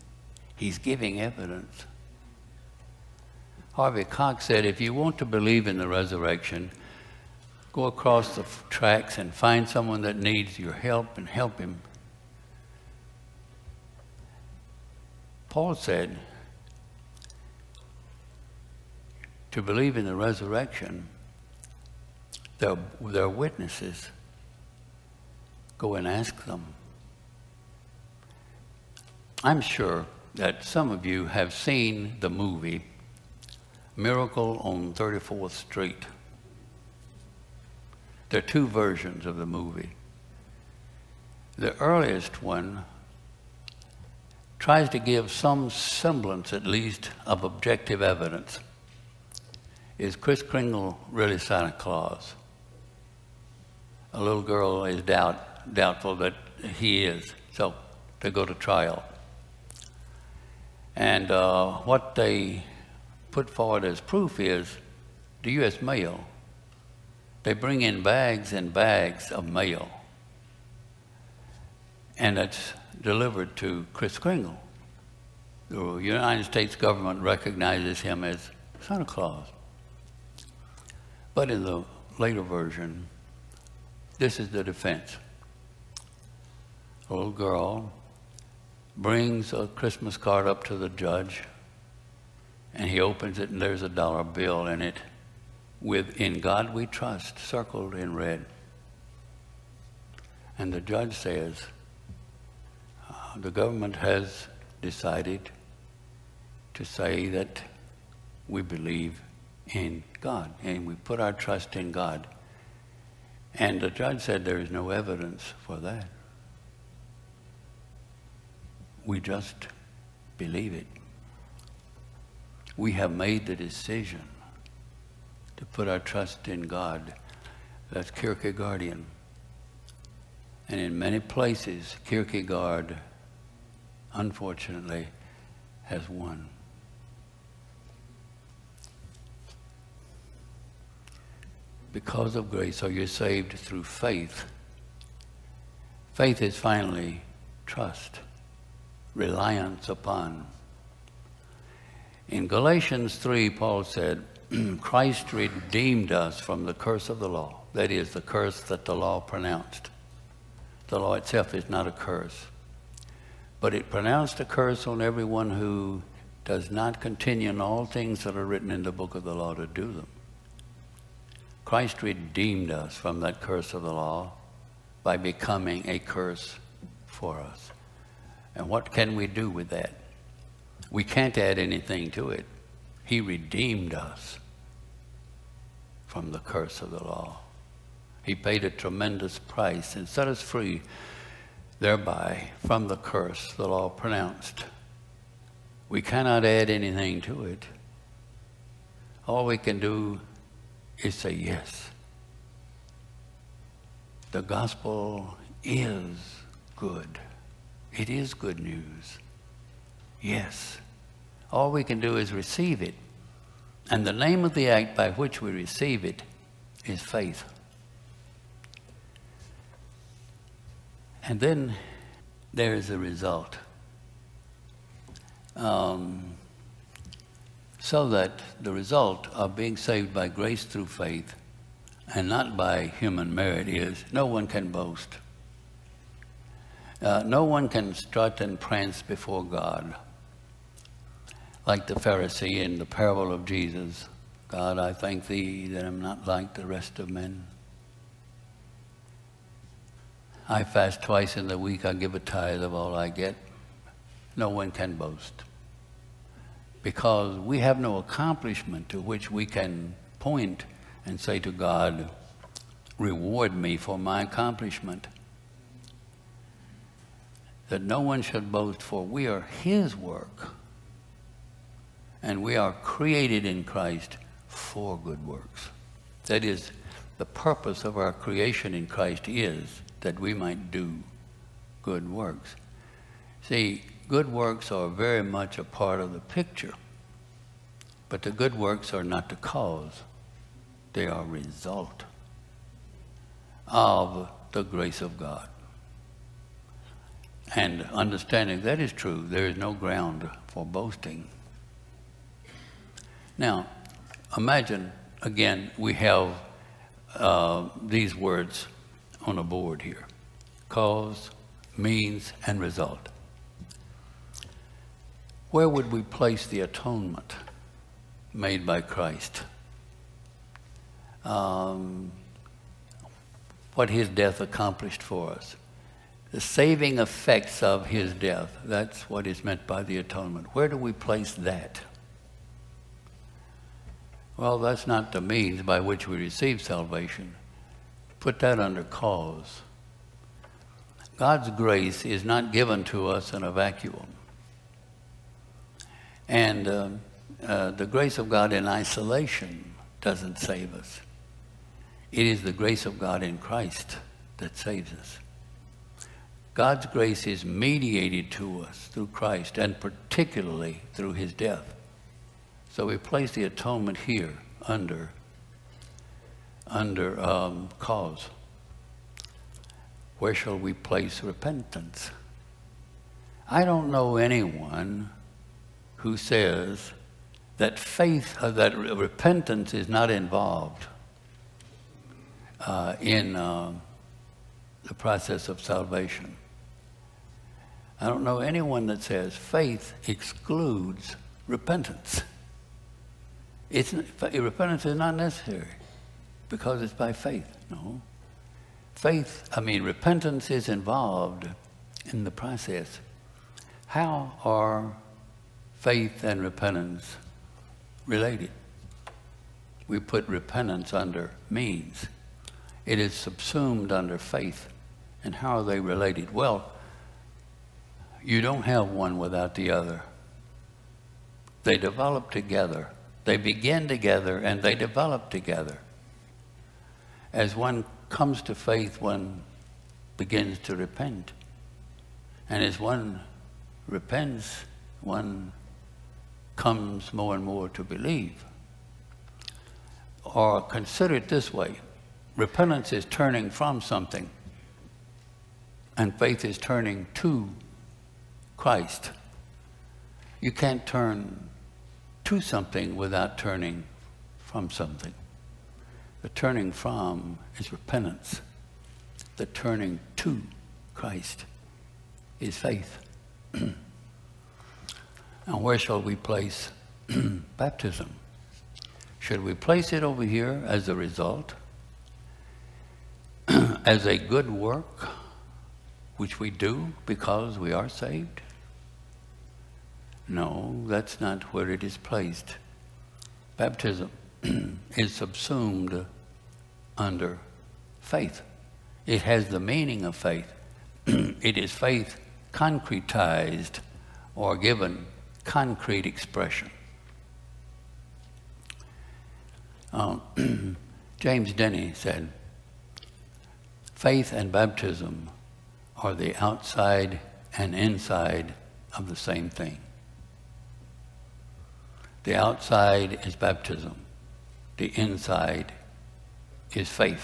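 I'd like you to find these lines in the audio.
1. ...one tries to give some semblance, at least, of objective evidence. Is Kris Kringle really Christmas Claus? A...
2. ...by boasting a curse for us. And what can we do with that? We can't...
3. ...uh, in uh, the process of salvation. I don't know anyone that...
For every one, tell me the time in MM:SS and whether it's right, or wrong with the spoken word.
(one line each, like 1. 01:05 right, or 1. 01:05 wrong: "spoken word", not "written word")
1. 00:42 wrong: "Santa", not "Christmas"
2. 02:55 wrong: "becoming", not "boasting"
3. 06:22 right.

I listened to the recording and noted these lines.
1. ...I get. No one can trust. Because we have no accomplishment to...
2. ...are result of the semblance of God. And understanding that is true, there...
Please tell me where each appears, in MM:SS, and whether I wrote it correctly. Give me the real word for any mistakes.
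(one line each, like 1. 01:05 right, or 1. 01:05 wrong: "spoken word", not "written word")
1. 04:12 wrong: "boast", not "trust"
2. 04:51 wrong: "grace", not "semblance".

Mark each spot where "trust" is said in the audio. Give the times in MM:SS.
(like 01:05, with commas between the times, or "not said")
01:36, 01:51, 02:05, 02:27.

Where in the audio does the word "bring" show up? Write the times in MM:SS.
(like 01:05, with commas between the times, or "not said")
01:07, 01:28.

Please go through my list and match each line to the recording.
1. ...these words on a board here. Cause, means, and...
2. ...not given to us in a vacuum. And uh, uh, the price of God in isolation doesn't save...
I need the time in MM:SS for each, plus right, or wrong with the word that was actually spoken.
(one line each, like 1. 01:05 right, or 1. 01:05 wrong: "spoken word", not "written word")
1. 05:07 right
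2. 05:42 wrong: "grace", not "price".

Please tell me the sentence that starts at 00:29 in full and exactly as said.
I'm sure that some of you have seen the movie Miracle on 34th Street.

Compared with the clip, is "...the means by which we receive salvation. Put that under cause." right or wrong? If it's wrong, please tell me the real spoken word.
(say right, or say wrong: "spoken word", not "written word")
right.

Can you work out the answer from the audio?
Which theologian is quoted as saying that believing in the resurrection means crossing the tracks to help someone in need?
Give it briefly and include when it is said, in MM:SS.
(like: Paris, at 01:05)
Harvey Cox, at 00:03.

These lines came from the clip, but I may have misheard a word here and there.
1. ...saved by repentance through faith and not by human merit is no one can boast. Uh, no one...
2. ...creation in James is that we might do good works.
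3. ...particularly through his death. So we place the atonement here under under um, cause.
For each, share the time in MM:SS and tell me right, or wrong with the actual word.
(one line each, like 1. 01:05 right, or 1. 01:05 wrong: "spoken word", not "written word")
1. 03:49 wrong: "grace", not "repentance"
2. 04:38 wrong: "Christ", not "James"
3. 05:59 right.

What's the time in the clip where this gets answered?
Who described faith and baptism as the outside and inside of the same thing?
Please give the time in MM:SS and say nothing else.
08:21.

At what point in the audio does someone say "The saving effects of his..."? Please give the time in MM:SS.
05:26.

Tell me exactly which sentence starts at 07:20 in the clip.
Or consider it this way repentance is turning from something, and faith is turning to Christ.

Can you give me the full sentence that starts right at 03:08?
He paid a tremendous price and set us free thereby from the curse the law pronounced.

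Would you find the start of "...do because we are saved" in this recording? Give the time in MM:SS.
07:56.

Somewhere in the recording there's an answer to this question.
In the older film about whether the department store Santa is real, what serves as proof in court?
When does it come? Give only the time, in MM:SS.
01:05.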